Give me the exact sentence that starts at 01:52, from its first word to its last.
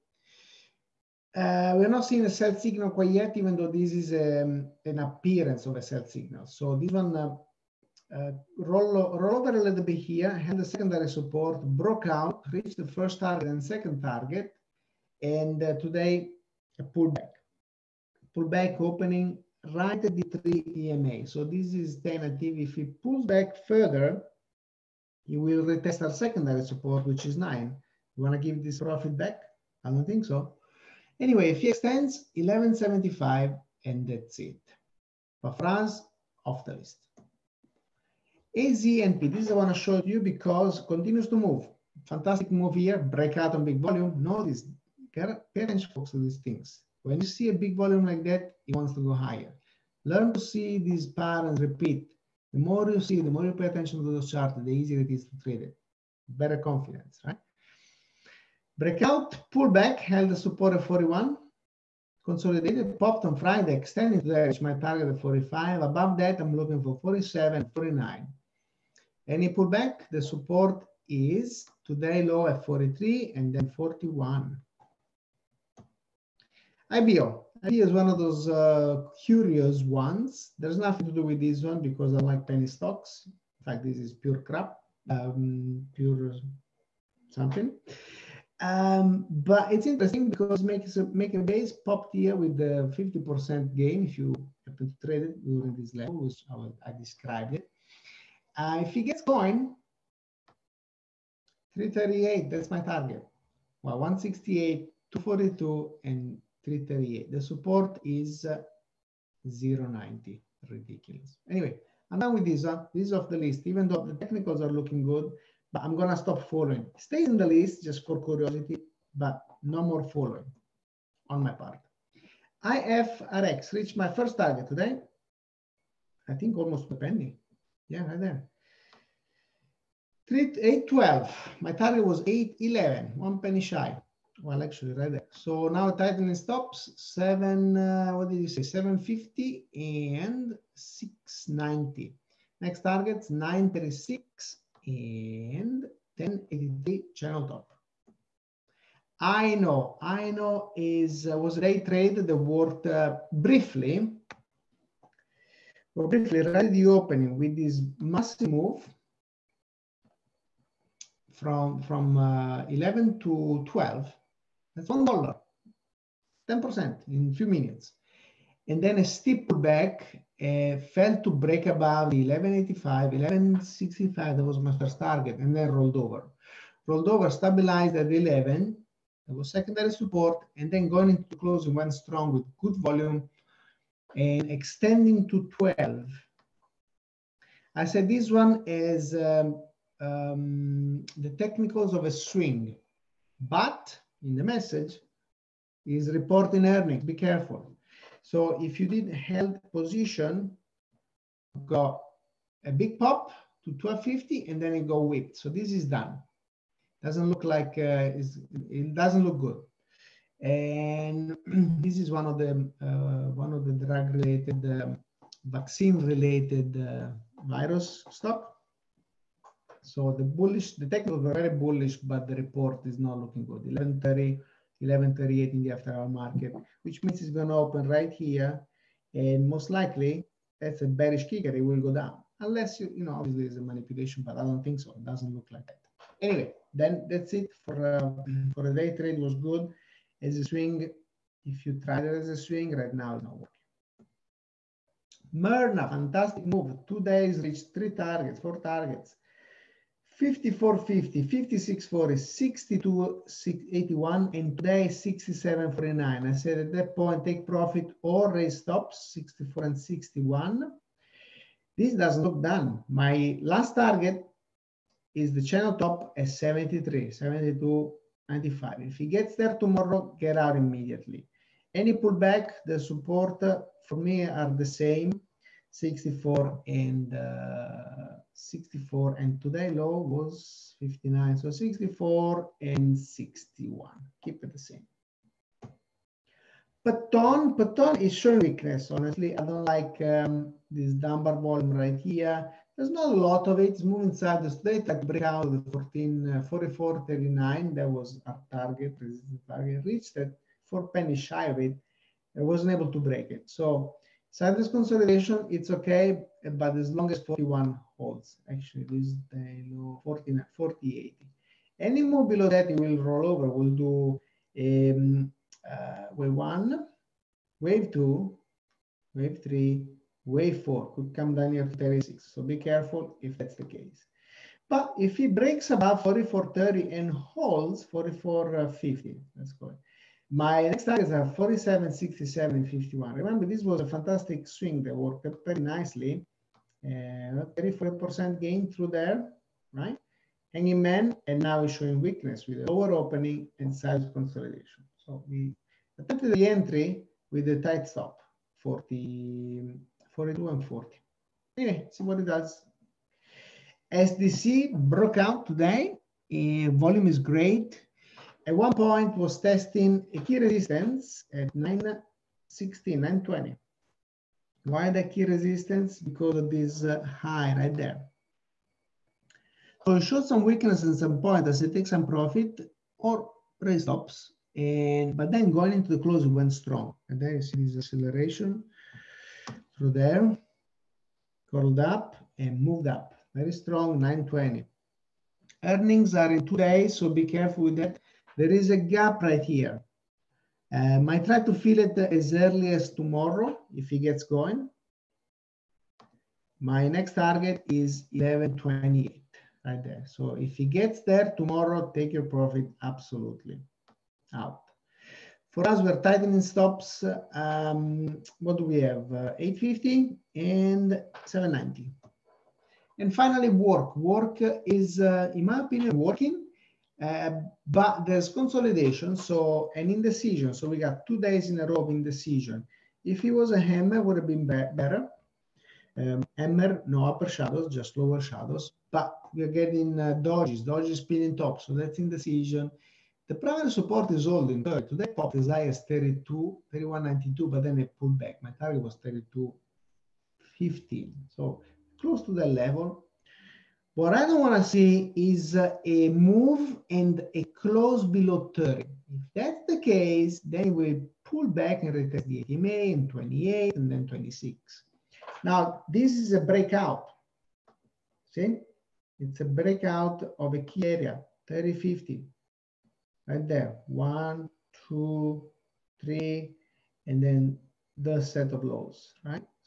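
Uh, this is off the list, even though the technicals are looking good but I'm gonna stop following.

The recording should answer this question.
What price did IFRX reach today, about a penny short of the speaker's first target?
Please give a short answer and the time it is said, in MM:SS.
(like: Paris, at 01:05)
8.12, at 02:10.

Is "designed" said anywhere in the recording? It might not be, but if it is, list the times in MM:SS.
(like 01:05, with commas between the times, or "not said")
not said.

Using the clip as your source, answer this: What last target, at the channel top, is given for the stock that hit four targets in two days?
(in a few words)
72.95.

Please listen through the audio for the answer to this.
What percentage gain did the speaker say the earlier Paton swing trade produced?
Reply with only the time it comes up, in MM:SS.
05:37.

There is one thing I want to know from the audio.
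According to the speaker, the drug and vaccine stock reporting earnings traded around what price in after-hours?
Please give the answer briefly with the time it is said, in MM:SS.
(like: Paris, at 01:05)
11.30, at 03:43.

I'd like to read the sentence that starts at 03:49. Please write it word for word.
And most likely, that's a bearish kicker.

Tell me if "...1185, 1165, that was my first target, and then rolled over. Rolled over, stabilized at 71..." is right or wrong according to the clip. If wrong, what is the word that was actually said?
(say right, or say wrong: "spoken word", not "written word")
wrong: "11", not "71".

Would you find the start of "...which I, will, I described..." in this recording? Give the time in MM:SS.
01:36.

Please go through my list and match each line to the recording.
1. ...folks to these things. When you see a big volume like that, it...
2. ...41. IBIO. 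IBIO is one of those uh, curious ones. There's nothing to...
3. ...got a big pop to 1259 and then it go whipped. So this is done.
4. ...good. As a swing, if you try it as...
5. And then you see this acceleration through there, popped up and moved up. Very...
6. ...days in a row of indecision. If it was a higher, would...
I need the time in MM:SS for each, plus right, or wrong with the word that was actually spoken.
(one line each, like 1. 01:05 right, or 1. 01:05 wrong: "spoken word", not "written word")
1. 00:45 right
2. 01:13 right
3. 03:21 wrong: "1250", not "1259"
4. 03:59 right
5. 06:17 wrong: "curled", not "popped"
6. 07:01 wrong: "hammer", not "higher".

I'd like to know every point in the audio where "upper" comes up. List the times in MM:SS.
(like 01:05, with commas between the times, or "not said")
07:07.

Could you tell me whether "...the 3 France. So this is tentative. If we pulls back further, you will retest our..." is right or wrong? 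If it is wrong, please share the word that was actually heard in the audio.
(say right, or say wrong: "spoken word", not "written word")
wrong: "EMA", not "France".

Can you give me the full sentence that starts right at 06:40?
So if he gets there tomorrow, take your profit absolutely out.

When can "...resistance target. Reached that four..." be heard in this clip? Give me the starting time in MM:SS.
04:58.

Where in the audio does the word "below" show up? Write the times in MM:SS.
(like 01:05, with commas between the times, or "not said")
05:12, 07:28.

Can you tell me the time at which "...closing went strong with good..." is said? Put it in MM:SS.
03:01.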